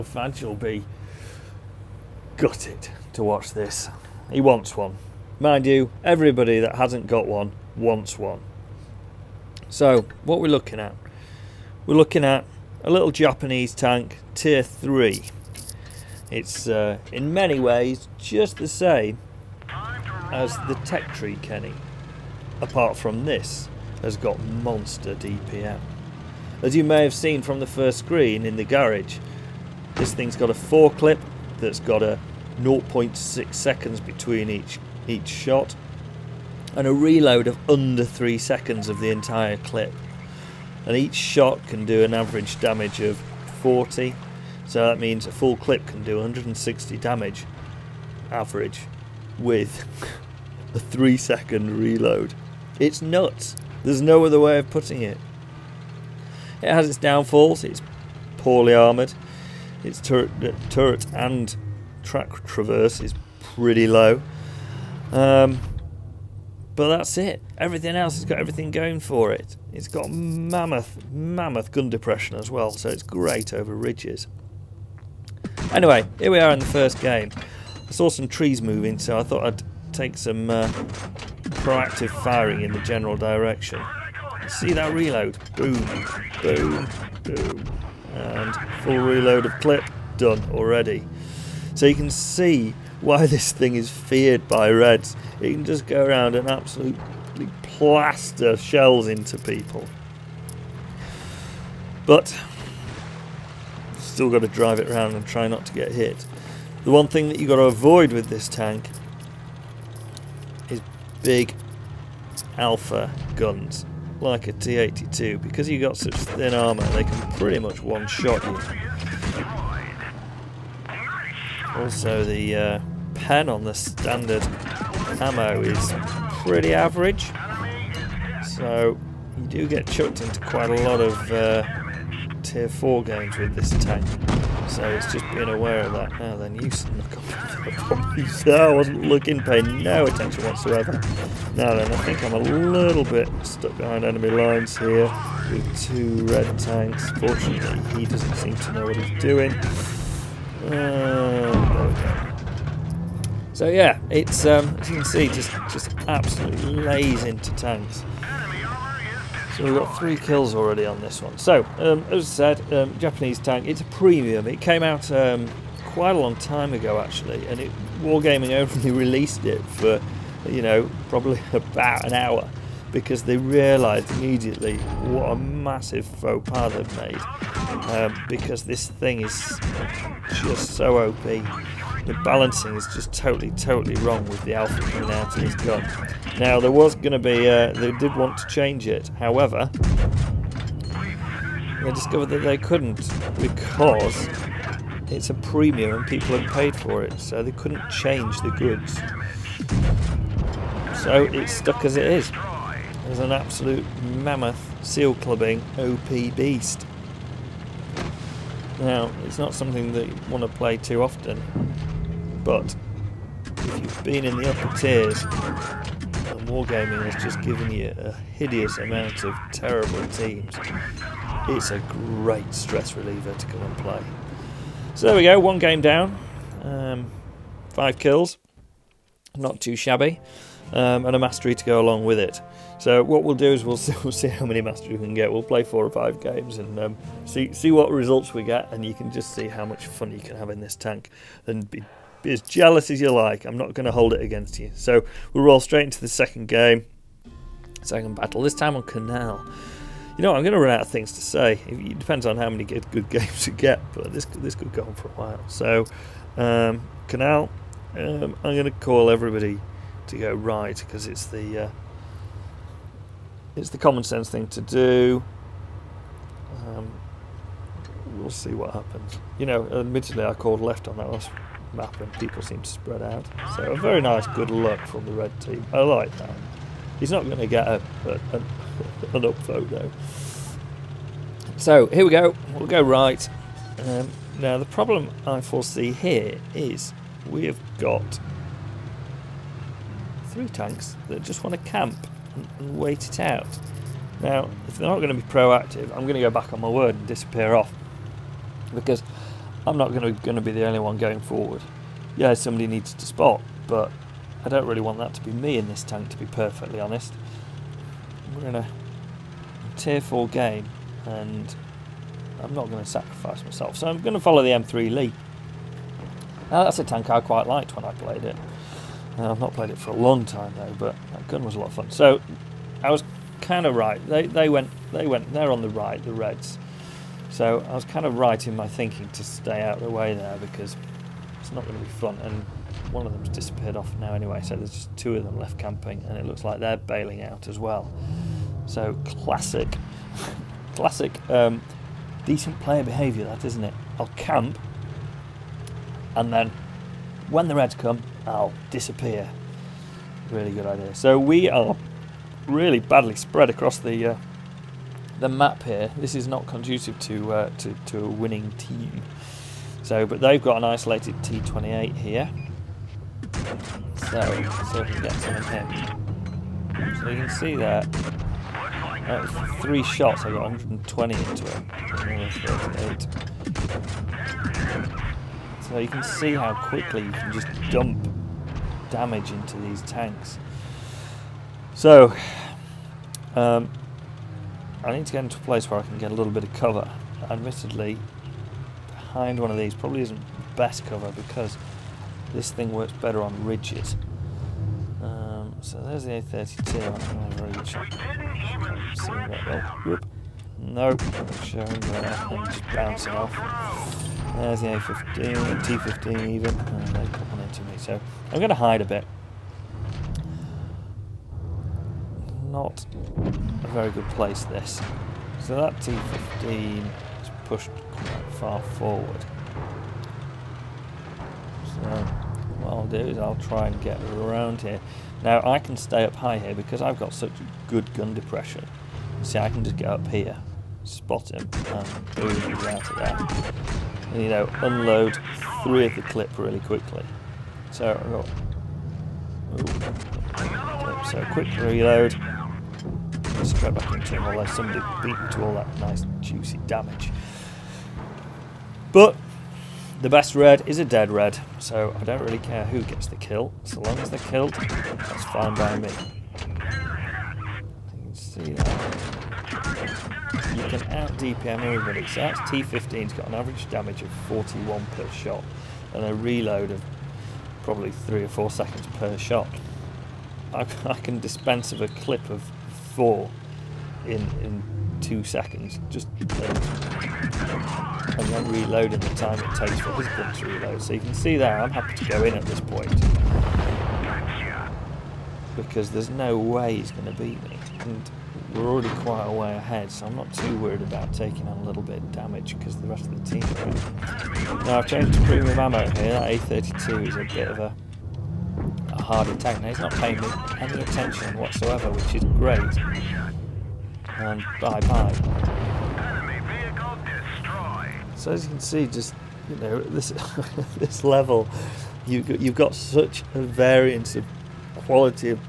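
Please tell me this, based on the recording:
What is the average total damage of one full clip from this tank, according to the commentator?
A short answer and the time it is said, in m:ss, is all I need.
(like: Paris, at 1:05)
160, at 0:46.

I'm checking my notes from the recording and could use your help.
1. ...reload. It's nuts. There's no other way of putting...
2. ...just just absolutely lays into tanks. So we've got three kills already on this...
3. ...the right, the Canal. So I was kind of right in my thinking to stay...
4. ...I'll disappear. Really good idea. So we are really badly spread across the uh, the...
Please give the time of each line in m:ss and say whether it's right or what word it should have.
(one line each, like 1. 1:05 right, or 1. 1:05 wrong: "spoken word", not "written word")
1. 0:51 right
2. 2:35 right
3. 5:25 wrong: "Reds", not "Canal"
4. 5:48 right.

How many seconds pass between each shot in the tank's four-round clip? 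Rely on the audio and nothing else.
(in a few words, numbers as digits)
0.6 seconds.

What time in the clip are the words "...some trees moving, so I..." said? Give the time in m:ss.
1:18.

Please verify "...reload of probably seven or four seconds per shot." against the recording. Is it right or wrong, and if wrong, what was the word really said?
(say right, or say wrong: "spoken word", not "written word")
wrong: "three", not "seven".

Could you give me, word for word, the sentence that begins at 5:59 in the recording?
So, but they've got an isolated T28 here.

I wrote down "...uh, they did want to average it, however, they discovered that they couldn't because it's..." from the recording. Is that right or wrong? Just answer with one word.
wrong.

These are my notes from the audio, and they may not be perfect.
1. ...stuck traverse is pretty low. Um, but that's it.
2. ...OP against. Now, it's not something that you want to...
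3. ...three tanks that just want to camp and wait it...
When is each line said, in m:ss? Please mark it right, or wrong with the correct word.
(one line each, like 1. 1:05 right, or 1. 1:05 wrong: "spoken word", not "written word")
1. 1:02 wrong: "track", not "stuck"
2. 3:25 wrong: "beast", not "against"
3. 4:50 right.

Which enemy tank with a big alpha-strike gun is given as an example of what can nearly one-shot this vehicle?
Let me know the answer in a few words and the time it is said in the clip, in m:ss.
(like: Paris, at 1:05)
T-82, at 1:54.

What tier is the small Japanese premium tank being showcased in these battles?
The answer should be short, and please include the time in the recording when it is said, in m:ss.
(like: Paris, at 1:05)
Tier 3, at 0:14.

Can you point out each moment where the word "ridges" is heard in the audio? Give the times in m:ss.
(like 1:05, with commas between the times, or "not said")
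1:13, 6:33.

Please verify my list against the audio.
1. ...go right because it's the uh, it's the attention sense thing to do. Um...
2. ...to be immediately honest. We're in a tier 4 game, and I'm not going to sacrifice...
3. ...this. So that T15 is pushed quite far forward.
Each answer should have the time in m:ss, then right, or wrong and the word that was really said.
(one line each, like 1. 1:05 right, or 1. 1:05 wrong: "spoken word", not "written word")
1. 4:20 wrong: "common", not "attention"
2. 5:06 wrong: "perfectly", not "immediately"
3. 6:54 right.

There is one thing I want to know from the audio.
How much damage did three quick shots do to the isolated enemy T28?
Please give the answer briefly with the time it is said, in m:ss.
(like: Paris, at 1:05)
120, at 6:10.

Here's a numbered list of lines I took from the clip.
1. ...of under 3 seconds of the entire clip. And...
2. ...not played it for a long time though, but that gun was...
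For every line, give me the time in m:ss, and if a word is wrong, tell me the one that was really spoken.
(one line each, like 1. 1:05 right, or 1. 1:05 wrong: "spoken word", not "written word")
1. 0:37 right
2. 5:19 right.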